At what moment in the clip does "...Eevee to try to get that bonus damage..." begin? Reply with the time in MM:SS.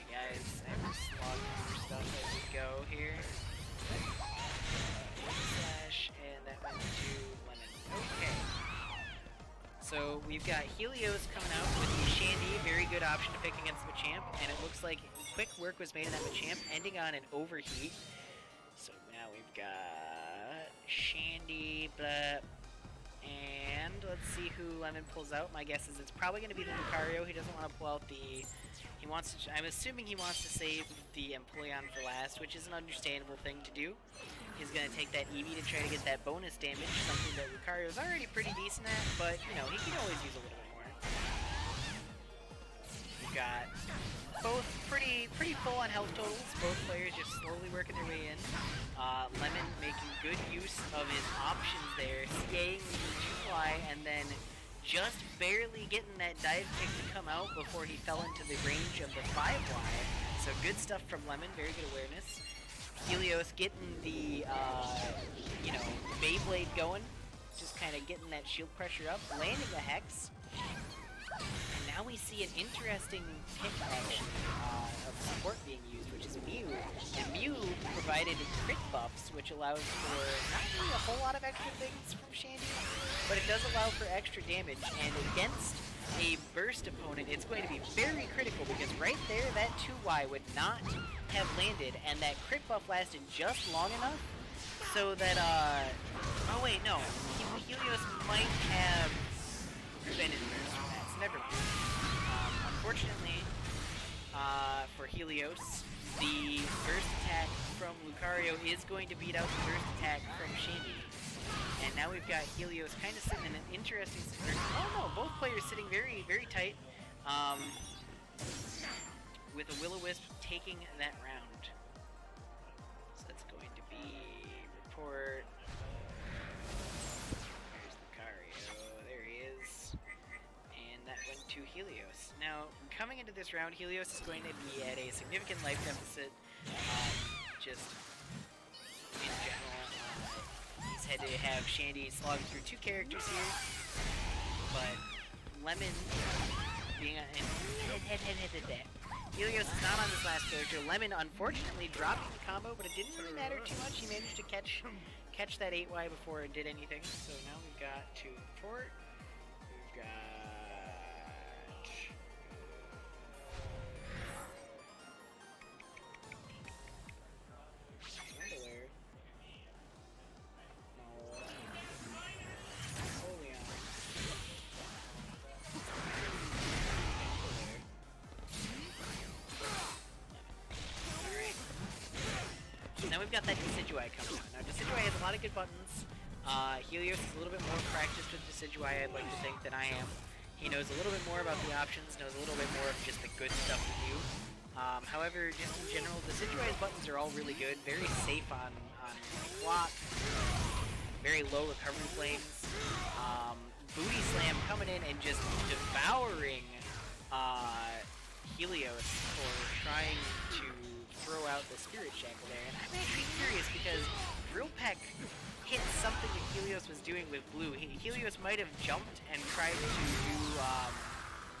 00:35.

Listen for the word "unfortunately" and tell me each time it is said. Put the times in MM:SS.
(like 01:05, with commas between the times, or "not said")
01:42, 02:31.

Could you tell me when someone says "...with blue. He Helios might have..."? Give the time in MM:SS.
03:37.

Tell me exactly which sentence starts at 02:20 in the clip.
Uh, he's had to have Shandy slog through two characters here, but Lemon being on...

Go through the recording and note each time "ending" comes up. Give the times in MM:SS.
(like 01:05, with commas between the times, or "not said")
00:16.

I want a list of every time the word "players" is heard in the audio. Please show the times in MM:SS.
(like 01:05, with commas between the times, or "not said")
00:46, 01:55.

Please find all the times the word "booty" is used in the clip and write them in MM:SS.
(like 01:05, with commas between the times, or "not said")
03:23.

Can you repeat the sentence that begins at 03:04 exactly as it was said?
Now, Decidueye has a lot of good buttons.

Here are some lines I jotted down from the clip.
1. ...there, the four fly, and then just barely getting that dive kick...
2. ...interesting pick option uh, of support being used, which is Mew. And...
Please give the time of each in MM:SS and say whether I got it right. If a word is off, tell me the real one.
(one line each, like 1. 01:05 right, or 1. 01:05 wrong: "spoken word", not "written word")
1. 00:51 wrong: "two", not "four"
2. 01:12 right.